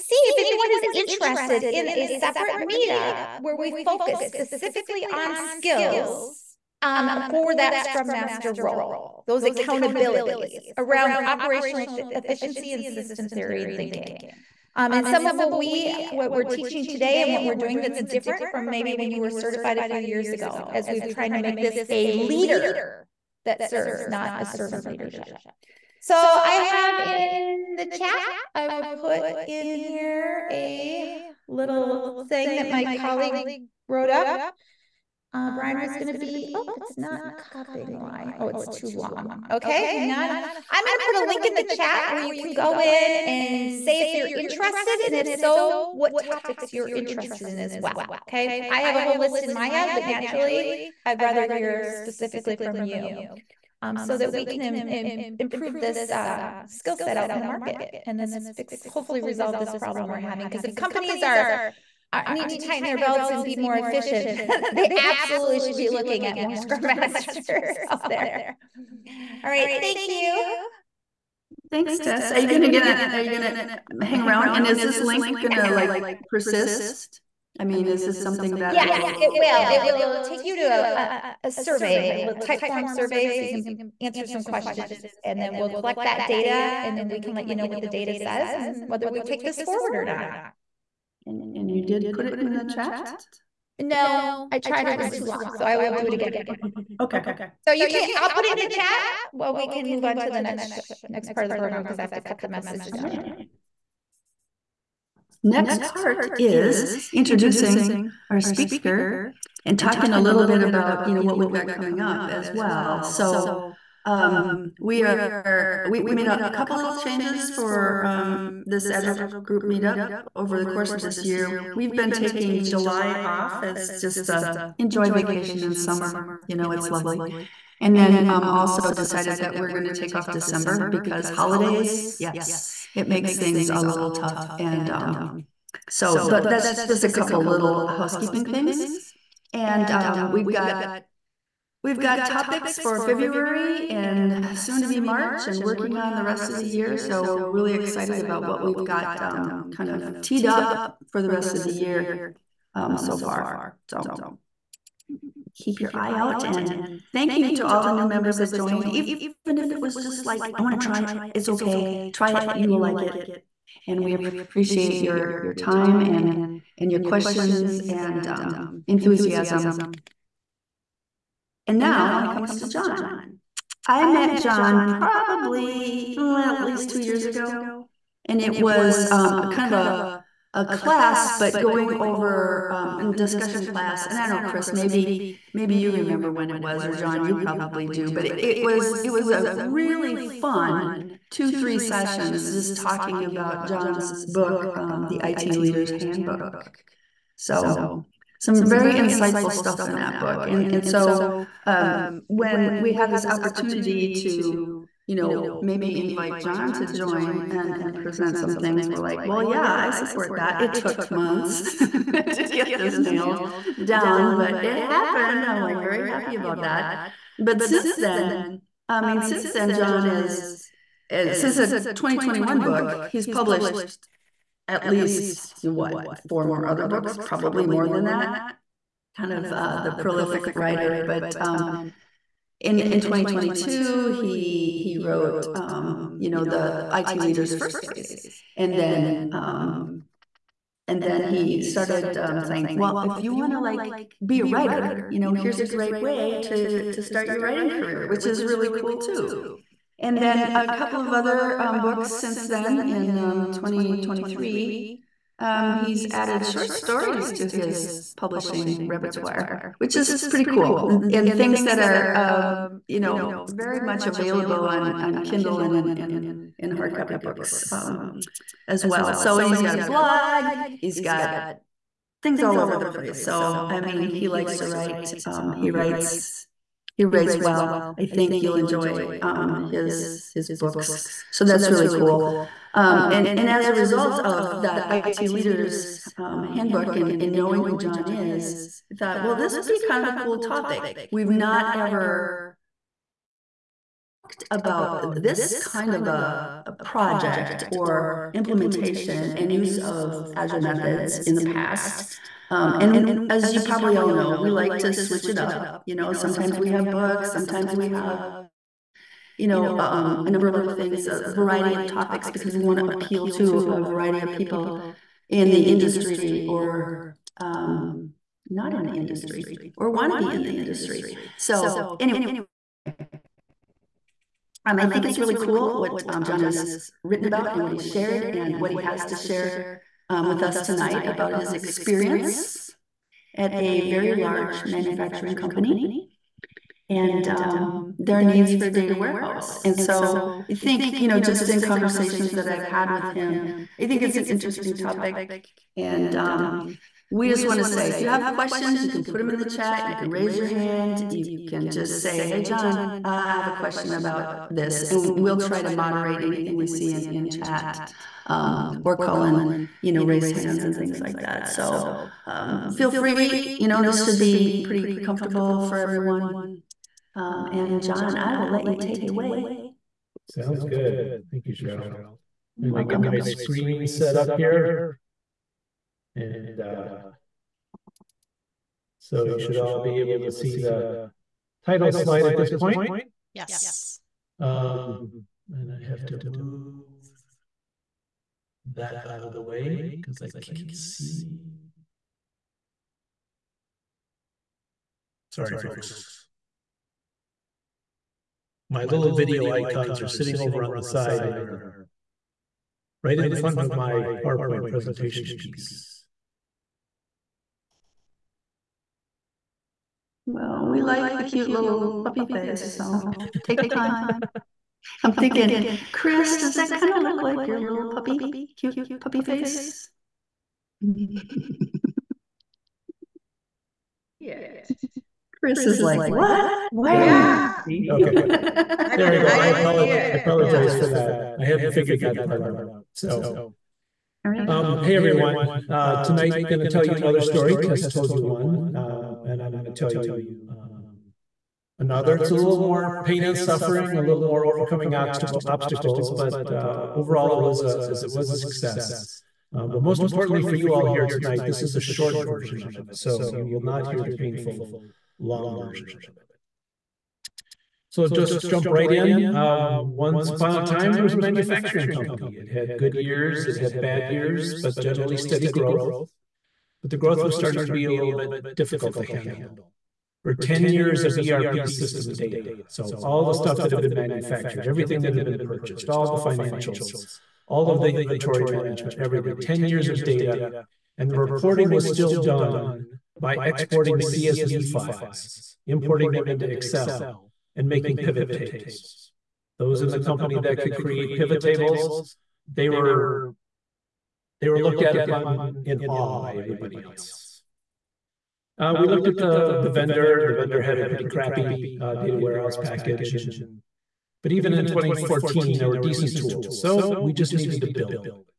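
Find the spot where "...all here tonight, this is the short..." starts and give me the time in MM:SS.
07:30.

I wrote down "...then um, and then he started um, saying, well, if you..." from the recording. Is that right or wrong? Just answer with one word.
right.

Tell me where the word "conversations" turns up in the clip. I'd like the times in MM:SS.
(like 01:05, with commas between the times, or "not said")
05:41.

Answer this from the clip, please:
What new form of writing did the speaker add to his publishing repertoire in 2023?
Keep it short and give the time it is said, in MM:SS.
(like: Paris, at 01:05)
Short stories, at 04:16.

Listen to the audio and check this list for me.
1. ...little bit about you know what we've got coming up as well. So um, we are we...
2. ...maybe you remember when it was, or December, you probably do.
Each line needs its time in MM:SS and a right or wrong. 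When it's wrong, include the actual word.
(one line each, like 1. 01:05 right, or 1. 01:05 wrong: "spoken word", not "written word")
1. 01:50 right
2. 03:05 wrong: "John", not "December".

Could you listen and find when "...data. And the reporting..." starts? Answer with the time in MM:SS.
08:00.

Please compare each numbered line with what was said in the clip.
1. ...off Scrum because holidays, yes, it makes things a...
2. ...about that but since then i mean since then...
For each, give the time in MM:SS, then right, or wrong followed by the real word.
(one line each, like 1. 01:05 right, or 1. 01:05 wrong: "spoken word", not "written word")
1. 02:10 wrong: "December", not "Scrum"
2. 03:36 right.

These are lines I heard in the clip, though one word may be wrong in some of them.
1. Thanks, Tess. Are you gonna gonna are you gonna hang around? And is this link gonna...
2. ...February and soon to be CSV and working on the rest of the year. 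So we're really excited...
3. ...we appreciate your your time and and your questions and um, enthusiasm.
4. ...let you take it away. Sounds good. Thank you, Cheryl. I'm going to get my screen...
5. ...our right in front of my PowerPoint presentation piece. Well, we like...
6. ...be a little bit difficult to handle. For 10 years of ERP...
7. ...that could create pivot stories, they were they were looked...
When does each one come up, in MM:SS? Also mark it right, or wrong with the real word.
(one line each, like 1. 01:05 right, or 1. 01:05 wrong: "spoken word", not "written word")
1. 01:11 right
2. 02:23 wrong: "March", not "CSV"
3. 02:44 right
4. 06:08 right
5. 06:41 right
6. 07:47 right
7. 08:10 wrong: "tables", not "stories".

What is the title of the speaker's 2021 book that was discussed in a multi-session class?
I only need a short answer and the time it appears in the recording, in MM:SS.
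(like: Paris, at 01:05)
The IT Leader's Handbook, at 03:15.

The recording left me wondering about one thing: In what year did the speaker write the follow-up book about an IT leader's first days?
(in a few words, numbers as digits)
2022.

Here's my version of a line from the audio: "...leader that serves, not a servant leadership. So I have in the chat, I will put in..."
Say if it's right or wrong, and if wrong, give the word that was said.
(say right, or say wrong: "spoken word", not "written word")
right.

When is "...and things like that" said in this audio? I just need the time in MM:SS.
06:00.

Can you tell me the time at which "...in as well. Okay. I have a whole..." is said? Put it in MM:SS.
00:47.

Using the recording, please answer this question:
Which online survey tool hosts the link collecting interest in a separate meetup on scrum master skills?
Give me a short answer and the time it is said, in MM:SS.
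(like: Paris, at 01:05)
Typeform, at 01:22.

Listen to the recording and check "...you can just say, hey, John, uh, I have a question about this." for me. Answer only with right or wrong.
right.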